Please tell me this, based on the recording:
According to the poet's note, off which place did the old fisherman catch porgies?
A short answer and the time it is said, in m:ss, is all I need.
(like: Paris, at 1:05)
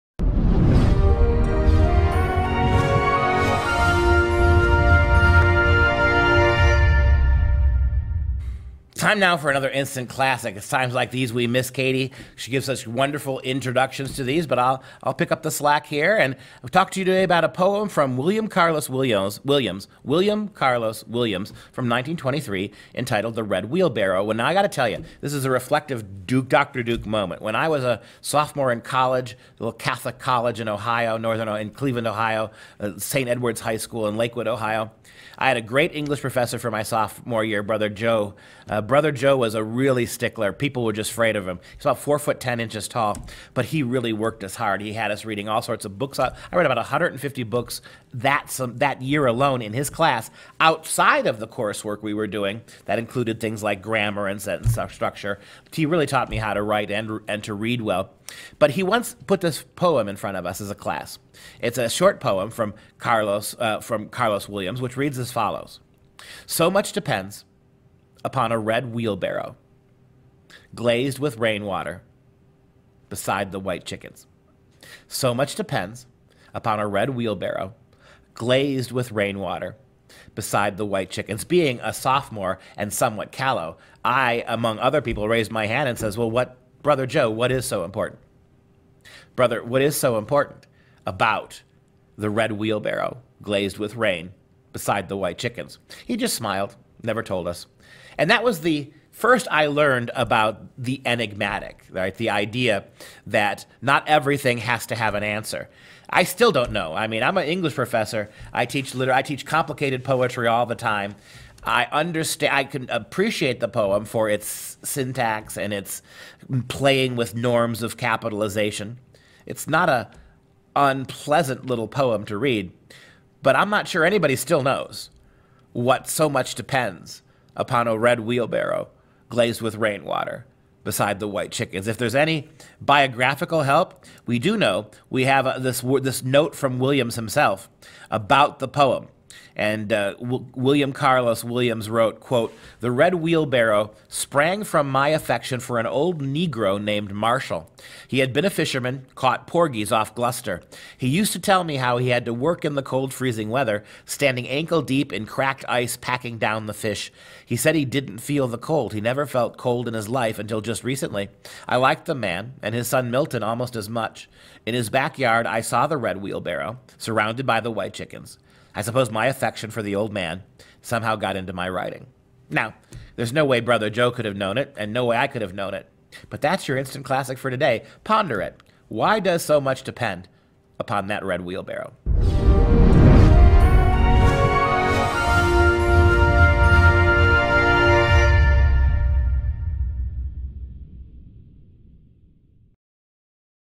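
Gloucester, at 2:30.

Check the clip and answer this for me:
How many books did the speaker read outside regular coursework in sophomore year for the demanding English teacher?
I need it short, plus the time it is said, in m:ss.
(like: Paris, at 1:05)
150, at 0:46.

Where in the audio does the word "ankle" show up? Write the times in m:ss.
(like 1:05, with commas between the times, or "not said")
2:34.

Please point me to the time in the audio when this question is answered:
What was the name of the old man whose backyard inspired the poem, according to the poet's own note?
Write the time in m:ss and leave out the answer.
2:27.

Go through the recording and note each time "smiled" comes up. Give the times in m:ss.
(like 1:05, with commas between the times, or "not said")
1:36.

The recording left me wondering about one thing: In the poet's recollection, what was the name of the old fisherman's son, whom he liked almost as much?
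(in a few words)
Milton.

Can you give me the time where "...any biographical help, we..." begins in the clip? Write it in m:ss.
2:12.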